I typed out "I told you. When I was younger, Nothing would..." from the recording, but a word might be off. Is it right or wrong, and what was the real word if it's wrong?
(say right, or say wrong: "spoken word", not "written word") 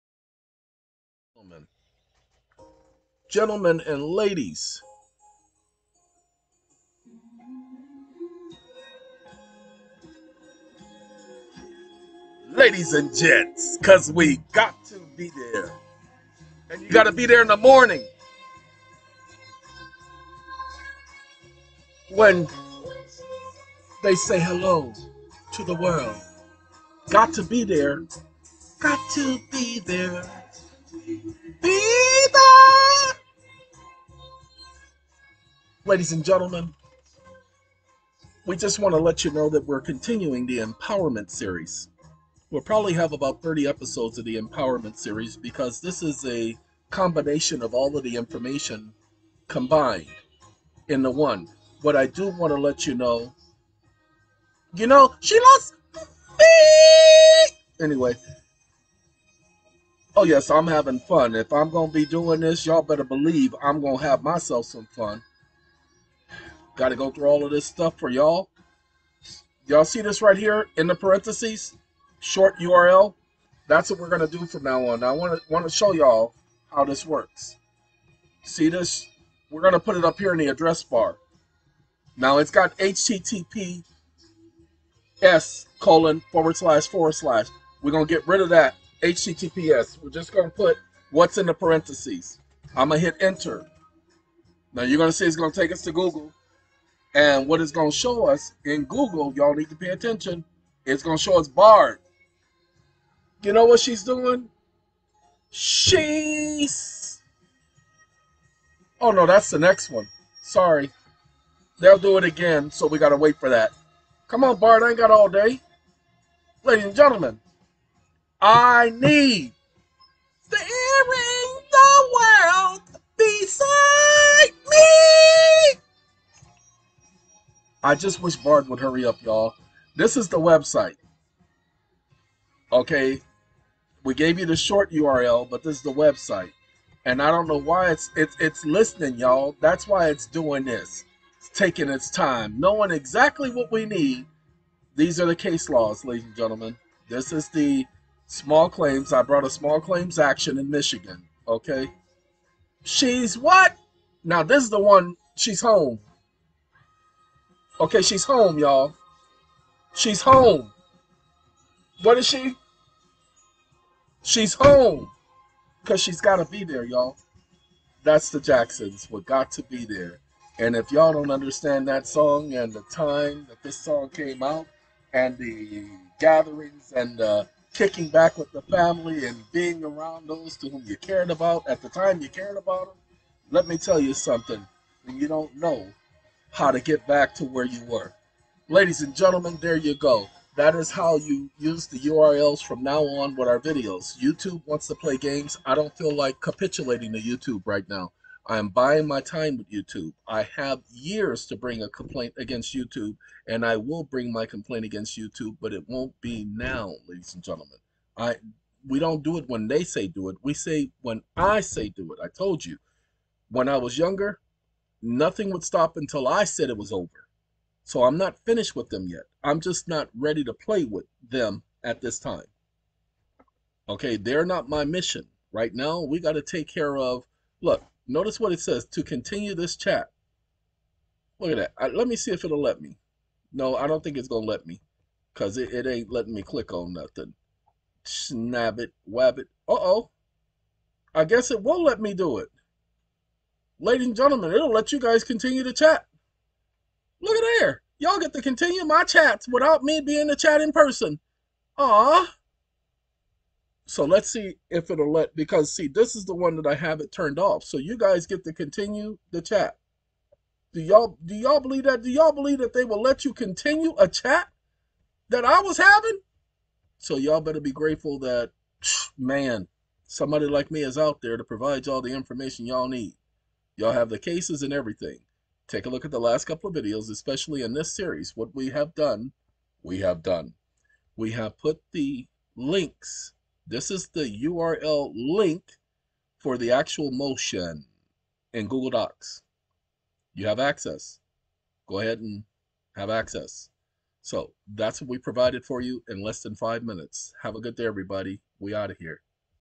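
right.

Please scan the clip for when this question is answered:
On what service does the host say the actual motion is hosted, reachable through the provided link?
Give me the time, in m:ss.
4:48.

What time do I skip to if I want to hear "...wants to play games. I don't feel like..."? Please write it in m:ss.
3:14.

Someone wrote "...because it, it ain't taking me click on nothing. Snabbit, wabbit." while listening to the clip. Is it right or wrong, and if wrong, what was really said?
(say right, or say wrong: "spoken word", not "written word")
wrong: "letting", not "taking".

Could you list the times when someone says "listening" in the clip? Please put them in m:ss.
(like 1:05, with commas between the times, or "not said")
2:18.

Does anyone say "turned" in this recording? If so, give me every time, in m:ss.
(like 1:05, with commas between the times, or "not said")
4:17.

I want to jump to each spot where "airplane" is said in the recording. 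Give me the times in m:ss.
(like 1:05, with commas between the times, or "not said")
not said.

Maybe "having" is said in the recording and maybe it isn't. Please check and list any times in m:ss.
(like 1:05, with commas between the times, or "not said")
1:00, 4:25.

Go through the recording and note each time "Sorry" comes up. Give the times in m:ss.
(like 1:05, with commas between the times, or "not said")
1:50.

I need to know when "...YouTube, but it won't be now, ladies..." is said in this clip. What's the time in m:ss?
3:25.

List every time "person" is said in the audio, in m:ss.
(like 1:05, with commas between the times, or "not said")
4:10.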